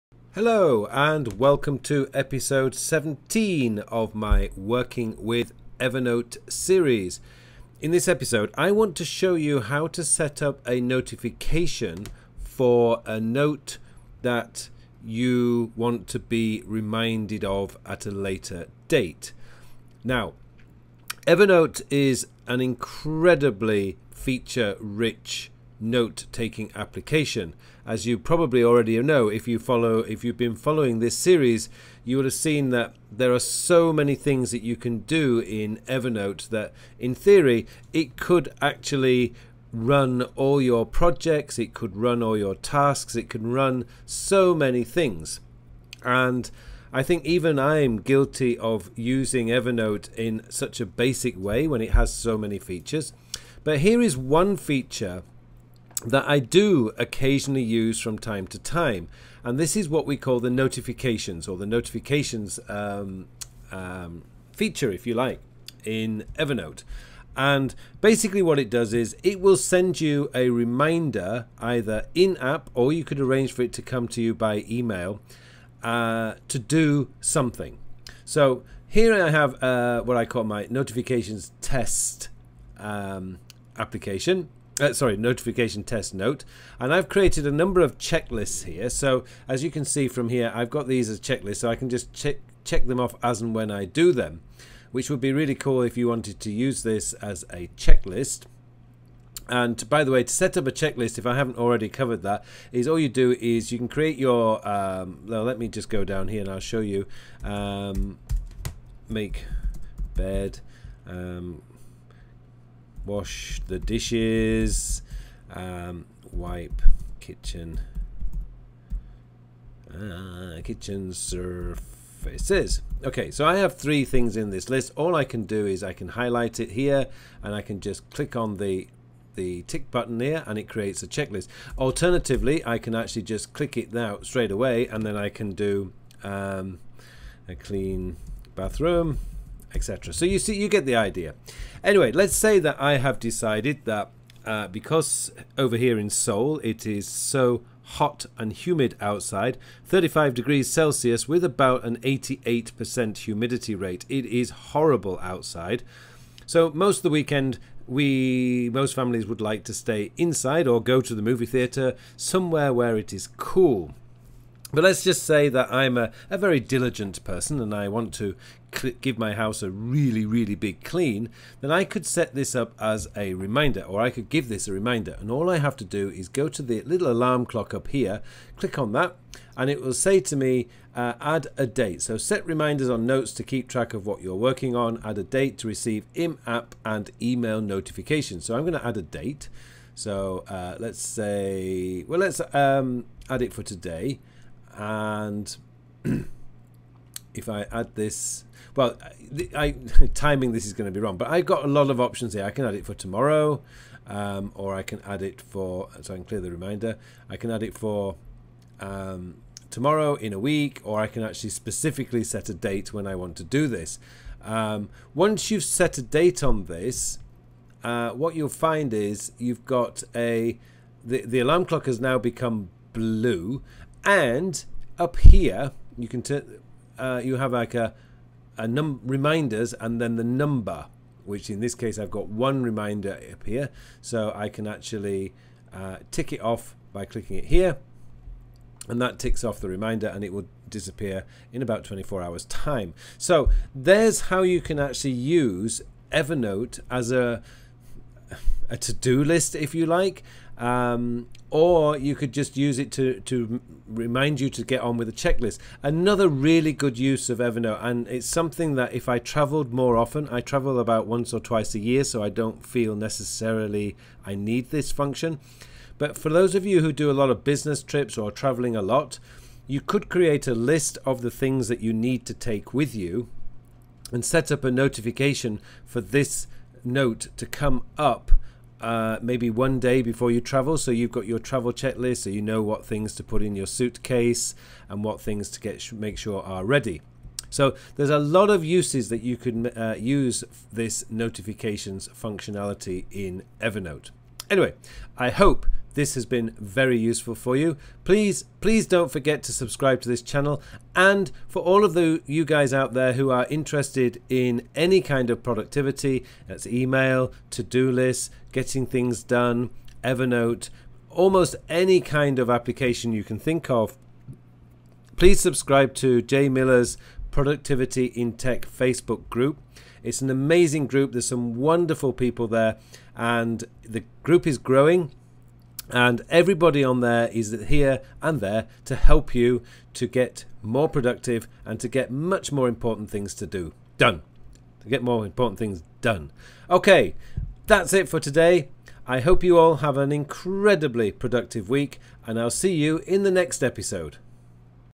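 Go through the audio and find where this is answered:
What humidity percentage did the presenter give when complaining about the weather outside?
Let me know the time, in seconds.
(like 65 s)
151 s.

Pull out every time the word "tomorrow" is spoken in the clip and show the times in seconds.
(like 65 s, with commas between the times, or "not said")
202 s, 209 s.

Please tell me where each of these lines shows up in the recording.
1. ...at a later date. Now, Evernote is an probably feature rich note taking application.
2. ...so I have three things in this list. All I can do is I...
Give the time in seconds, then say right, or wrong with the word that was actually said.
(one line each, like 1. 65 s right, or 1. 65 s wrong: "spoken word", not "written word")
1. 17 s wrong: "incredibly", not "probably"
2. 123 s right.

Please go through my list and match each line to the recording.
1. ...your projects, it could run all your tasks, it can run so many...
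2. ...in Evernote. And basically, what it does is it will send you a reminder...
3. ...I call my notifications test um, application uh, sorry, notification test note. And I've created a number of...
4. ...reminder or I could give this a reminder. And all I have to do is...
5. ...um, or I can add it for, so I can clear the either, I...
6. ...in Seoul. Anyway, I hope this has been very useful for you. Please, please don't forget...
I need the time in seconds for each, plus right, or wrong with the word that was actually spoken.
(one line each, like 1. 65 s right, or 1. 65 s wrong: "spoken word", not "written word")
1. 40 s right
2. 65 s right
3. 80 s right
4. 173 s right
5. 204 s wrong: "reminder", not "either"
6. 293 s wrong: "Evernote", not "Seoul".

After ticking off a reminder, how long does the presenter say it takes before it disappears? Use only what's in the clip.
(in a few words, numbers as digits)
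24 hours.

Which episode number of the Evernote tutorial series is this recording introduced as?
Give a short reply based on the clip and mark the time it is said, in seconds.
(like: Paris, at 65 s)
17, at 2 s.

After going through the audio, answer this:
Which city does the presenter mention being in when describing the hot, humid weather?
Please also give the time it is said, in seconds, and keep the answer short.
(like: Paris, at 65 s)
Seoul, at 146 s.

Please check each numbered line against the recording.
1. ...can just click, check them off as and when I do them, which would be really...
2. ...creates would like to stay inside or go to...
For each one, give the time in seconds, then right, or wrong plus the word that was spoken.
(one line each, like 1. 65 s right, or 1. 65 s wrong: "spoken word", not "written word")
1. 91 s wrong: "check", not "click"
2. 158 s wrong: "families", not "creates".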